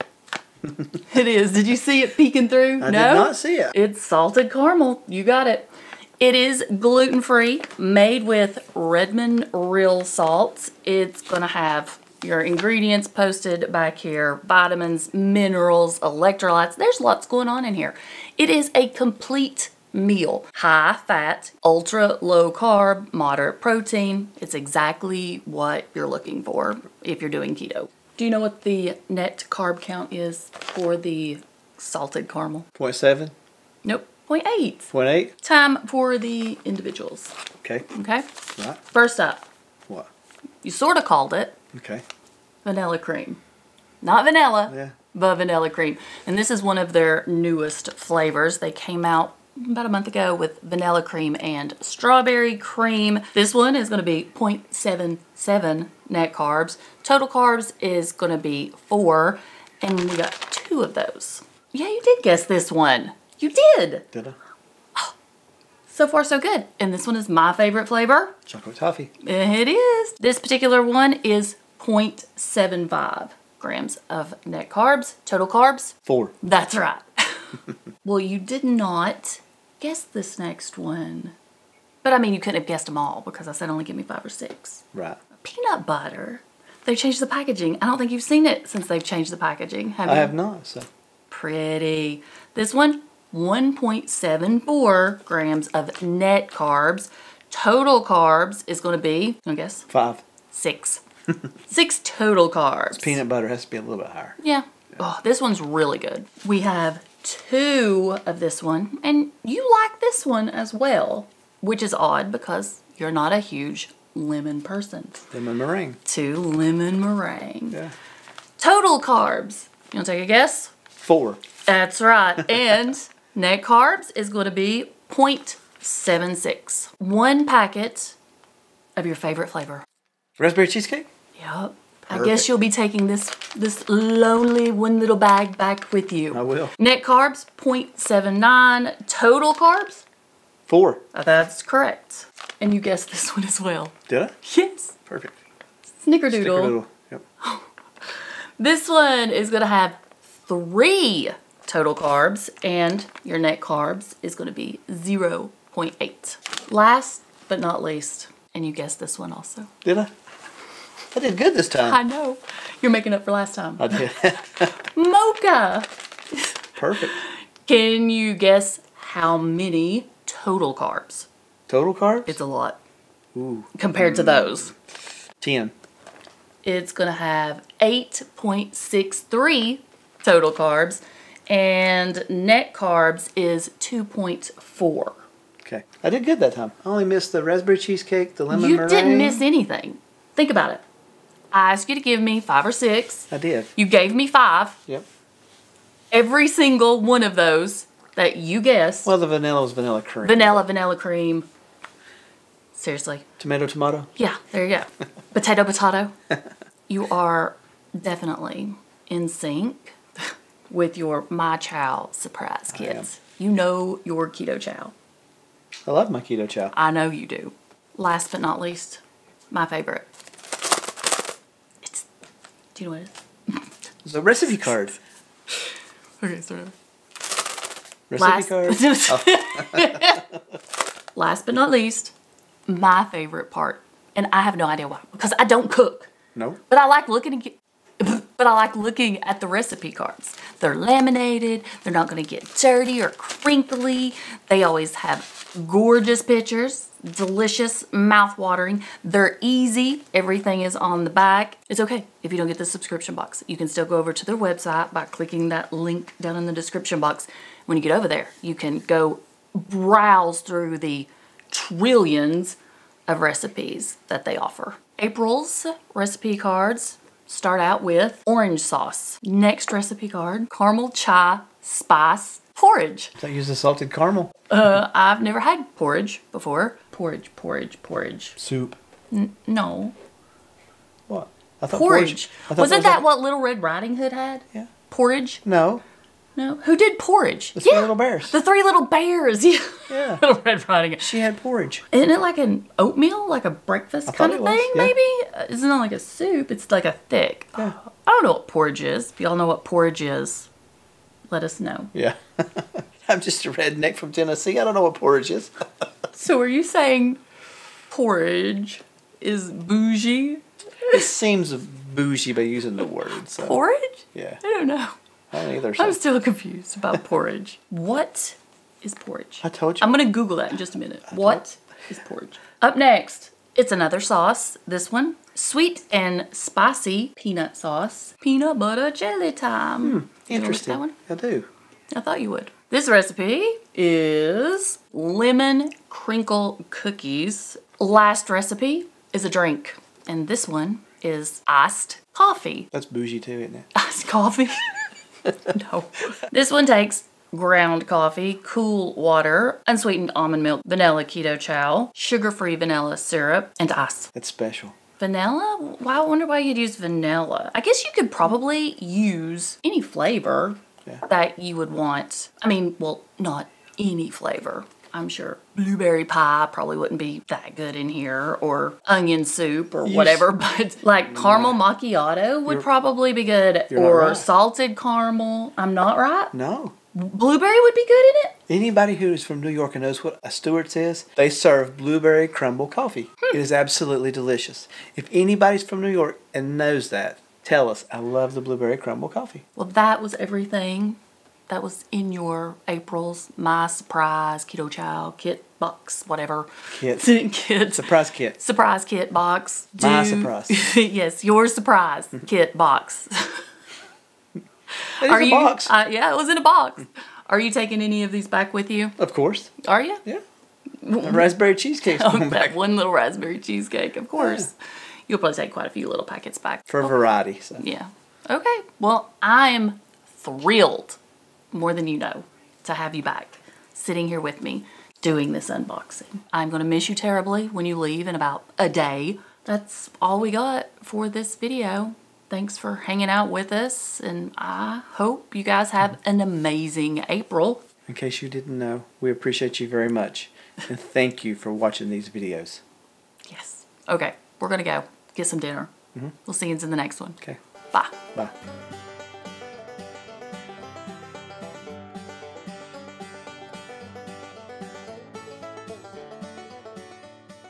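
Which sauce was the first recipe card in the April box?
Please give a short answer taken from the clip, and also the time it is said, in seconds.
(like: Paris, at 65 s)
Orange sauce, at 268 s.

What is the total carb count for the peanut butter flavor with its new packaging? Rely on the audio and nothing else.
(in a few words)
6.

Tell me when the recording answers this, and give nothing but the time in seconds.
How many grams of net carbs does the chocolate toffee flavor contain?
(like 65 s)
71 s.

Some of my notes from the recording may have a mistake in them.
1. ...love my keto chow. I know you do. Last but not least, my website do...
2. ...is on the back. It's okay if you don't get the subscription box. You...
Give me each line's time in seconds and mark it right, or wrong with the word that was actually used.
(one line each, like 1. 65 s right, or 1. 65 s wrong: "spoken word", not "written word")
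1. 215 s wrong: "favorite", not "website"
2. 250 s right.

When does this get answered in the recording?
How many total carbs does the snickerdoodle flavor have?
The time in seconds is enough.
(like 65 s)
150 s.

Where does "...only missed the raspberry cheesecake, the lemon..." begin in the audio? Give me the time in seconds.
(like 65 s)
186 s.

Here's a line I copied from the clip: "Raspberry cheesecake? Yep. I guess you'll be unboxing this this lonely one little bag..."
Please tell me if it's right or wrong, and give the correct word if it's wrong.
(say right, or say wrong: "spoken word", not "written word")
wrong: "taking", not "unboxing".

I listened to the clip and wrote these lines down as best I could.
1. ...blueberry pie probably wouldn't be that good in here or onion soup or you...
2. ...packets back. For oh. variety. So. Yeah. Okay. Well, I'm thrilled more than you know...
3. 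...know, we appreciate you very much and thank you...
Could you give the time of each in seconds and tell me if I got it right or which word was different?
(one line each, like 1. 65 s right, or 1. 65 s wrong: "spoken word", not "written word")
1. 365 s right
2. 416 s right
3. 438 s right.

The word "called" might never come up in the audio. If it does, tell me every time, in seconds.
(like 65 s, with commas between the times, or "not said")
41 s.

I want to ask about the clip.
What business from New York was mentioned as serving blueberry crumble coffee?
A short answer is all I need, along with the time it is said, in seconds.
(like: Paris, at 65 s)
Stewart's, at 380 s.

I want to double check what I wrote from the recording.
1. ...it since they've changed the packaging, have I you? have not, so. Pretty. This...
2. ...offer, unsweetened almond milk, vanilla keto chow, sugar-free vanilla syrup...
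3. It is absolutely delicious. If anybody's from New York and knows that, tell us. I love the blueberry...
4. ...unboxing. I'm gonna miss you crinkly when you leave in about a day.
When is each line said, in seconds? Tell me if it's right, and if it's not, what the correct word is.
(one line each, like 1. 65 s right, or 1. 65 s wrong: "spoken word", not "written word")
1. 88 s right
2. 348 s wrong: "water", not "offer"
3. 383 s right
4. 425 s wrong: "terribly", not "crinkly".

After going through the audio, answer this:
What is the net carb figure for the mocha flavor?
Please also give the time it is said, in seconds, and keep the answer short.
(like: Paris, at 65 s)
2.4, at 183 s.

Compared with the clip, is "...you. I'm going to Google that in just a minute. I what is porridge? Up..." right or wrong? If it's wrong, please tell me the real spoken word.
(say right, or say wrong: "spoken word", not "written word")
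right.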